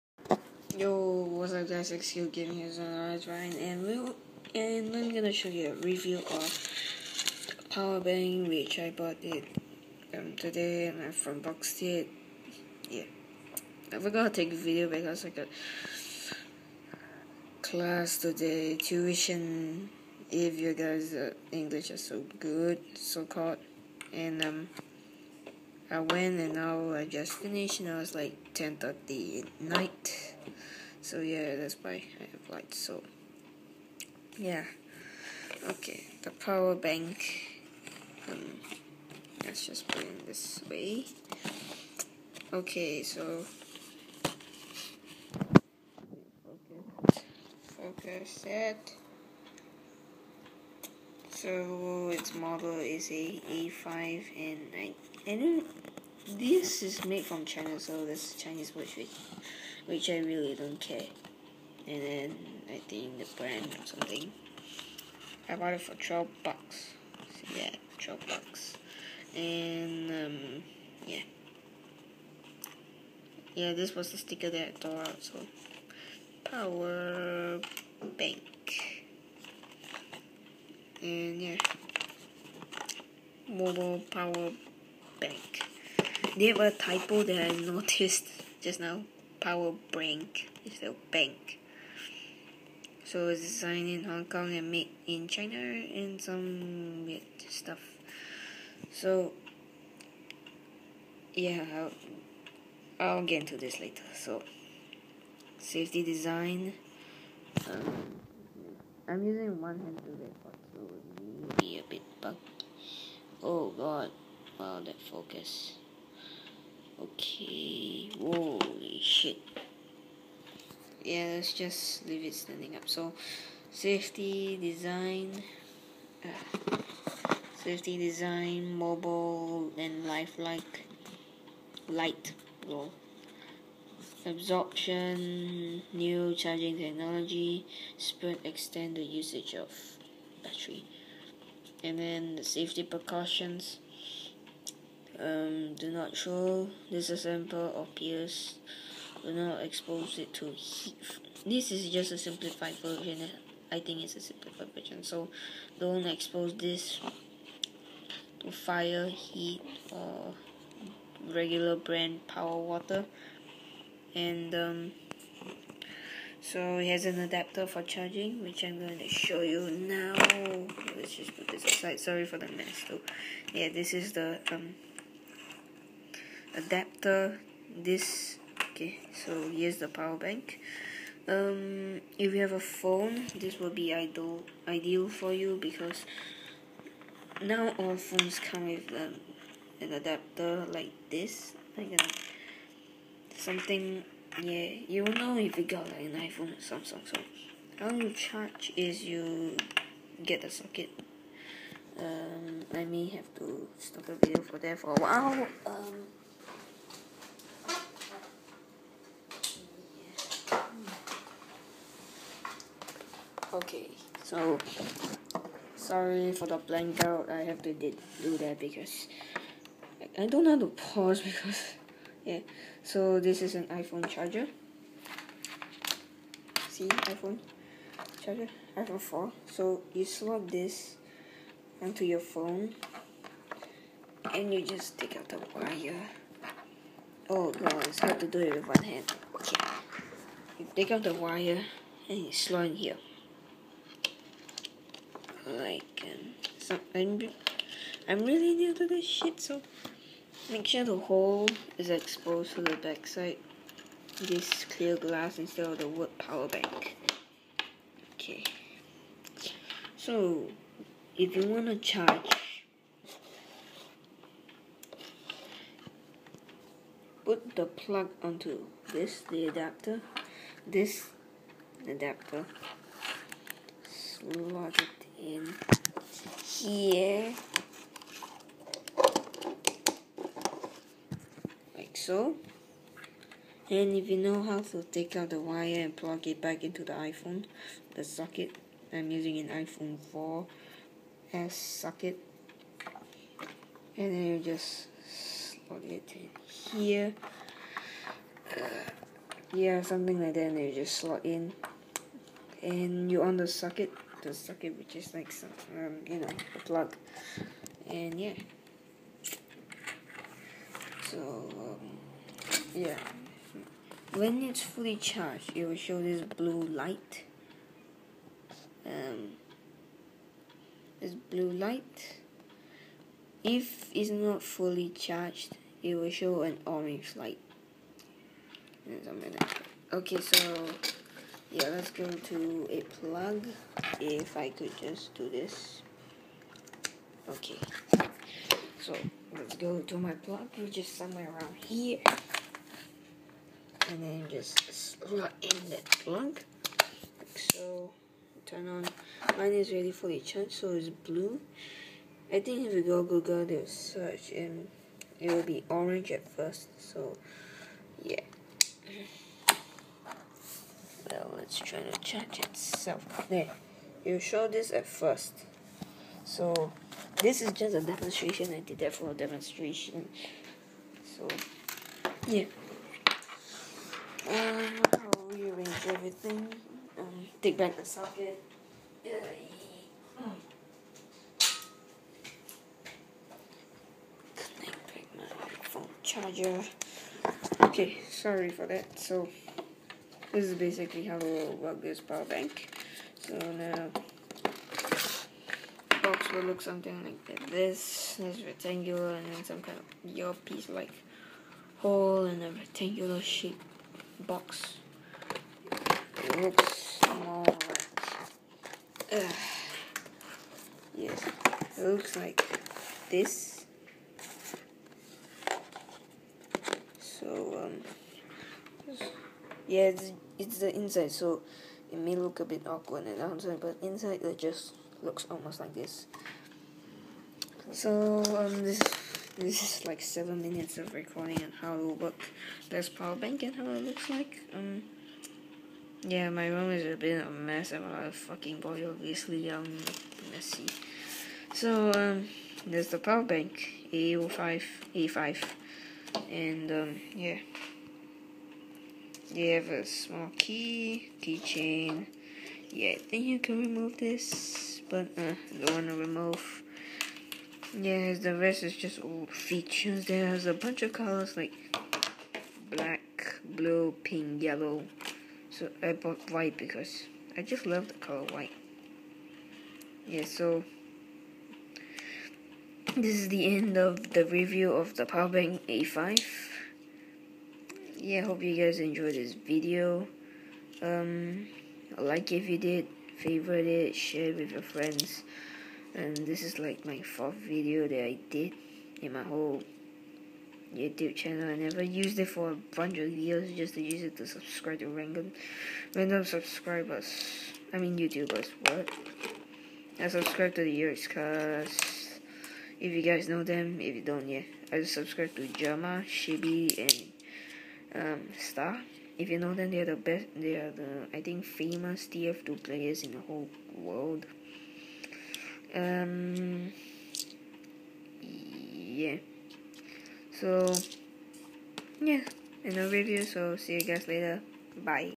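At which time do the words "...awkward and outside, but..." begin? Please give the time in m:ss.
7:02.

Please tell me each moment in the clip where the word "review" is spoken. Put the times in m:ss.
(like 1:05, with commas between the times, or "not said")
0:05, 7:54, 8:42.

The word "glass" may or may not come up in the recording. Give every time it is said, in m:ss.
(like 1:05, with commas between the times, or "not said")
4:14.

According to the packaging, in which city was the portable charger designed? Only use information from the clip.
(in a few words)
Hong Kong.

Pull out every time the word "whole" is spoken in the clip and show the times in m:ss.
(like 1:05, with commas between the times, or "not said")
8:09, 8:33.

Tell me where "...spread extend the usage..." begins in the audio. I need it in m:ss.
2:17.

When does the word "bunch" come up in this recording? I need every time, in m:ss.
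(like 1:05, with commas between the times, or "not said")
7:40, 8:12.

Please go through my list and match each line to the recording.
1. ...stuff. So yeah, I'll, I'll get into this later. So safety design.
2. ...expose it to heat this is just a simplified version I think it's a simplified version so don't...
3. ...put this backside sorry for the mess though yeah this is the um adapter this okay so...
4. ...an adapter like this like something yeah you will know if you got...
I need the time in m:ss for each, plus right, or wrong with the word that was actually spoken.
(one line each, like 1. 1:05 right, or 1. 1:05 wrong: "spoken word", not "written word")
1. 1:37 right
2. 2:29 right
3. 2:51 wrong: "aside", not "backside"
4. 3:09 right.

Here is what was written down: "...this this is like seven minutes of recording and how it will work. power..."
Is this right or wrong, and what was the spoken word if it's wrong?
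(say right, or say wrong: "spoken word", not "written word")
right.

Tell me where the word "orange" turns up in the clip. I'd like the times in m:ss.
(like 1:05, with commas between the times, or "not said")
5:26, 5:55.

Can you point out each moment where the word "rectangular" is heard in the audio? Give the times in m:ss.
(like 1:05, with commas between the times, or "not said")
6:38, 6:42.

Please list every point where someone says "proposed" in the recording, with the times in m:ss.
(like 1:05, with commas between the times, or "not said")
not said.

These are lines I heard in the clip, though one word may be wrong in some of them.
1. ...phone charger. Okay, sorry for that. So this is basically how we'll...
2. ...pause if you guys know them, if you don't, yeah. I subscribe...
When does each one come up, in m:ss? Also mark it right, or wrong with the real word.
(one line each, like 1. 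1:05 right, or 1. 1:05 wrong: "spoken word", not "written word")
1. 6:25 right
2. 8:21 wrong: "cause", not "pause".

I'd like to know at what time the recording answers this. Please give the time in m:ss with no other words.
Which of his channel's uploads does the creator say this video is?
8:07.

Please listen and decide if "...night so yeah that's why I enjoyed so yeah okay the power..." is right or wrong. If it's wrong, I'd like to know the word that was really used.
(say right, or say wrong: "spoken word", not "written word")
wrong: "applied", not "enjoyed".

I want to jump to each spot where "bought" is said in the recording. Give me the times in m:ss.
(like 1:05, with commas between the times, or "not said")
0:08, 1:05, 7:45.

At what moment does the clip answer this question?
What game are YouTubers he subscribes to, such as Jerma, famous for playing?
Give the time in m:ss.
8:32.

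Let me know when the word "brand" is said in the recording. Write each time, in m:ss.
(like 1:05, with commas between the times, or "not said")
1:03, 2:41.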